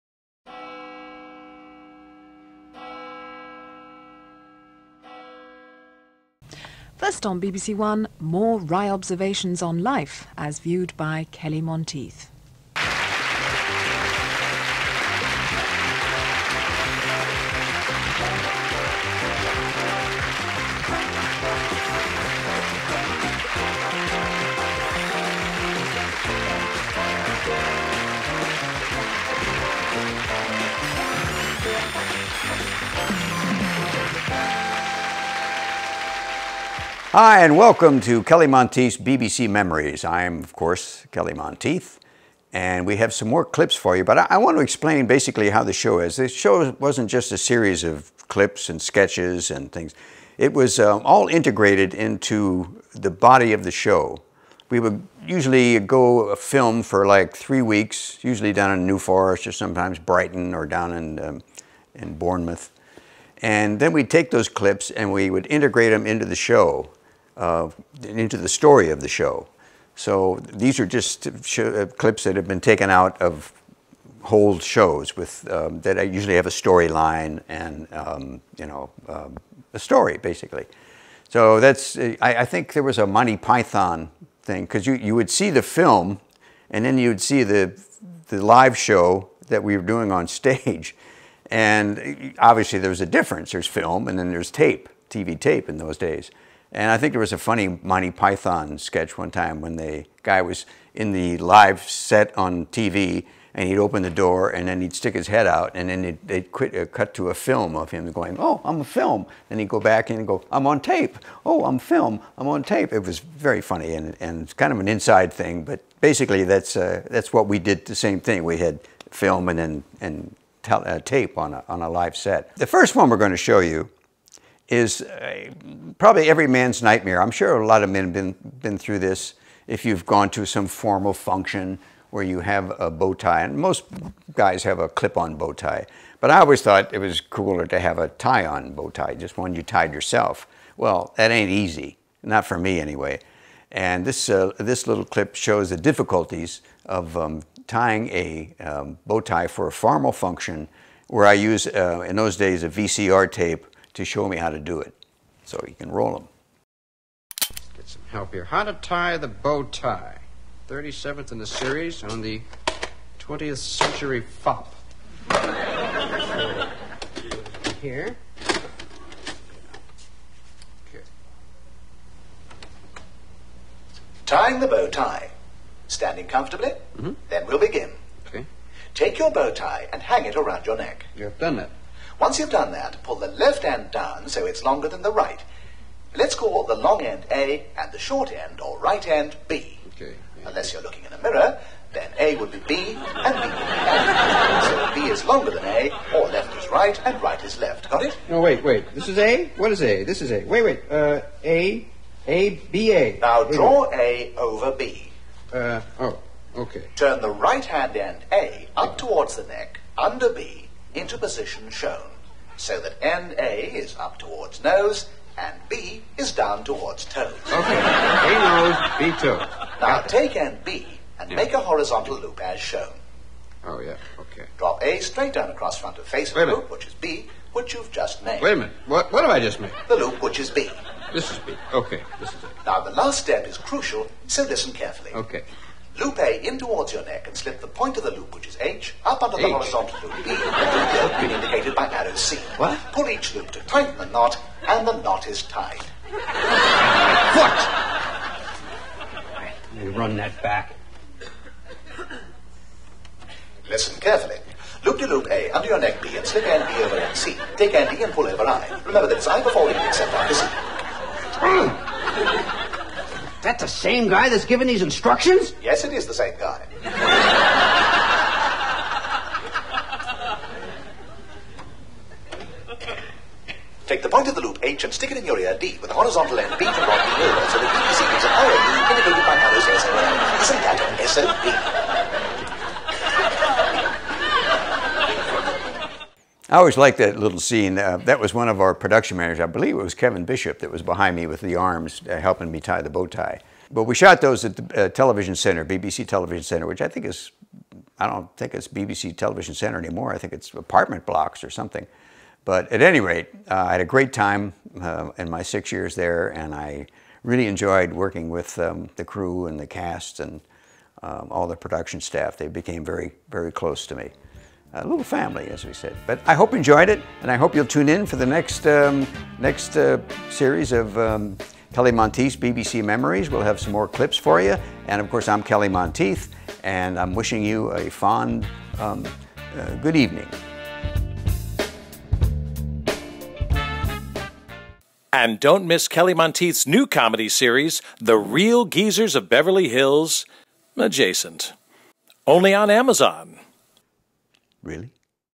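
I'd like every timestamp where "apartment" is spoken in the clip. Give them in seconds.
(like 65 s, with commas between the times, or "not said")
300 s.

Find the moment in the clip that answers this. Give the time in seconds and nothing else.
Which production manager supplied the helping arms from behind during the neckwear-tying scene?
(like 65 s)
289 s.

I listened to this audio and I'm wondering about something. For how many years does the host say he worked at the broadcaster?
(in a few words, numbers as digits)
6.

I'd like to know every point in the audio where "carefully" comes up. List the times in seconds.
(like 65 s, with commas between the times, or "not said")
234 s, 254 s.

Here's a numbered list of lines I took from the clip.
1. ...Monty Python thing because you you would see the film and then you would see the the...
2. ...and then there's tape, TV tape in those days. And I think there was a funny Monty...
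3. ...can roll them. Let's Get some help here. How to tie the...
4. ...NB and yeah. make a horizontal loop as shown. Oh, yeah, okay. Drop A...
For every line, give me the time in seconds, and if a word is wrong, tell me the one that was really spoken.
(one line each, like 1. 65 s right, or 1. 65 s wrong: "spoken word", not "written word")
1. 83 s right
2. 94 s right
3. 155 s right
4. 220 s right.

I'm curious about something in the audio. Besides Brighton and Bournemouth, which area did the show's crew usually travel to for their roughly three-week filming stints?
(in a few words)
New Forest.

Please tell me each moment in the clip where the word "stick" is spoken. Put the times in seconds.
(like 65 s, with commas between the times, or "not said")
104 s, 274 s.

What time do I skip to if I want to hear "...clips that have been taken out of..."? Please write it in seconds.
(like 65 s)
71 s.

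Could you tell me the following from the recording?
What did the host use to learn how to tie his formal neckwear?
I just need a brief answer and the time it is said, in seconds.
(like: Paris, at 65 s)
VCR tape, at 152 s.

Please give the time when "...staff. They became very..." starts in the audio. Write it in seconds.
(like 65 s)
312 s.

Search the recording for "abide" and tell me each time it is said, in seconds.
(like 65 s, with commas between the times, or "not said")
not said.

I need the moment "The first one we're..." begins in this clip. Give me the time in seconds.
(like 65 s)
122 s.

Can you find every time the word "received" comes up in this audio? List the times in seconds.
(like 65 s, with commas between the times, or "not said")
not said.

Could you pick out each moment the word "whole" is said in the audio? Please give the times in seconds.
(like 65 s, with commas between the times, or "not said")
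74 s.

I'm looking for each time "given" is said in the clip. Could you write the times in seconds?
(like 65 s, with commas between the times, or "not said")
264 s.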